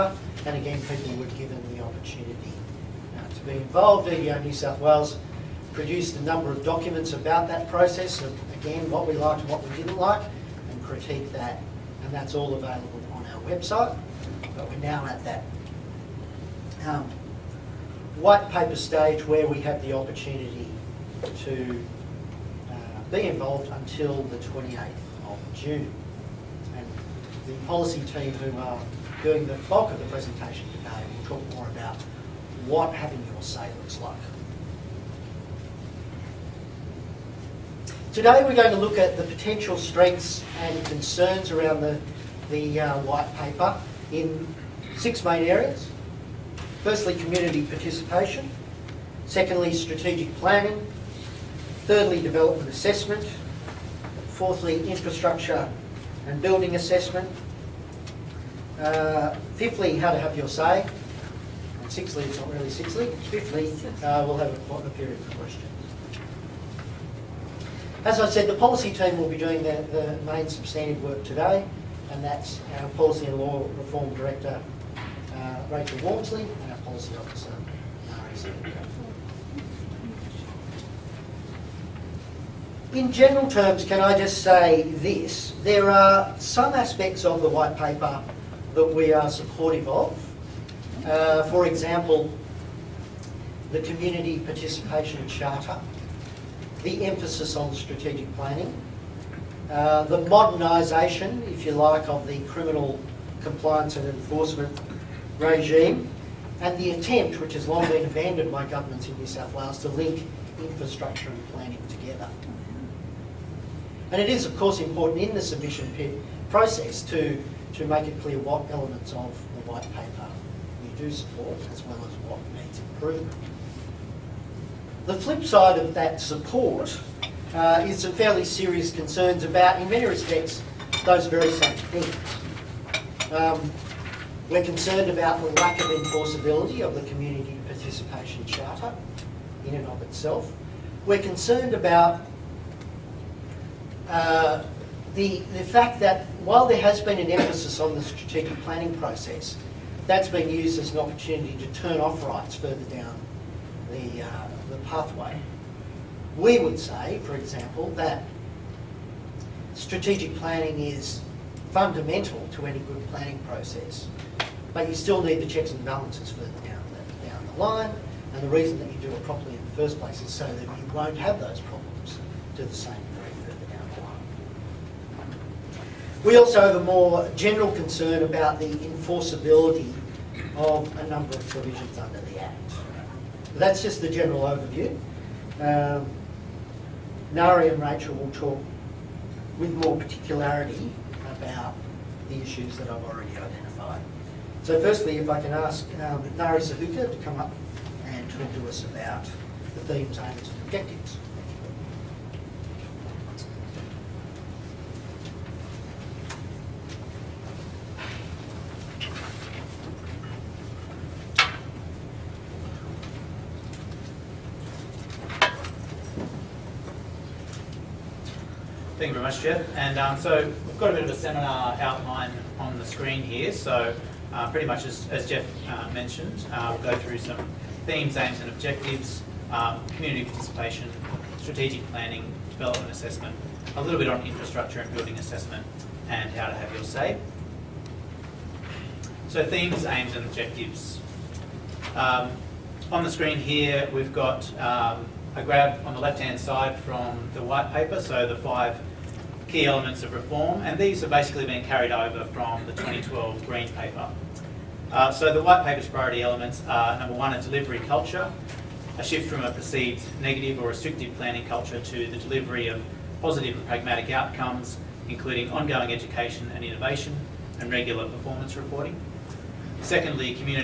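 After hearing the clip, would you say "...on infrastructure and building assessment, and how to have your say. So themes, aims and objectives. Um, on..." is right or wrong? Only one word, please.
right.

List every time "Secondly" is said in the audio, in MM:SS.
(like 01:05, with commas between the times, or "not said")
00:49, 04:29.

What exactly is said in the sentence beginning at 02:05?
The flip side of that support uh, is some fairly serious concerns about, in many respects, those very same things.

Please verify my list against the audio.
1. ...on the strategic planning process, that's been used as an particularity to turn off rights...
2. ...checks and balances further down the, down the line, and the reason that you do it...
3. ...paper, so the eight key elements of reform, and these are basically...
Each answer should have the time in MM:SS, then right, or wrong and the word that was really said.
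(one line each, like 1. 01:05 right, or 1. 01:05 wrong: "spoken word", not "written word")
1. 02:27 wrong: "opportunity", not "particularity"
2. 02:45 right
3. 04:07 wrong: "five", not "eight".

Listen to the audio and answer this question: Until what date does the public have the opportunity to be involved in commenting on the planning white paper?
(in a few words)
28th of June.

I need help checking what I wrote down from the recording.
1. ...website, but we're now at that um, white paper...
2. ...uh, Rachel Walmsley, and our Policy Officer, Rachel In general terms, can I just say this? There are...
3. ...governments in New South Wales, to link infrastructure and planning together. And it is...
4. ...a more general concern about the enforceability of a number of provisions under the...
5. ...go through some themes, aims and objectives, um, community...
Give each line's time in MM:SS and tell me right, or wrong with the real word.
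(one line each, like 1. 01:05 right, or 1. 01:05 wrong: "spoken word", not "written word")
1. 00:13 right
2. 01:15 wrong: "Nari", not "Rachel"
3. 01:48 right
4. 02:56 right
5. 03:46 right.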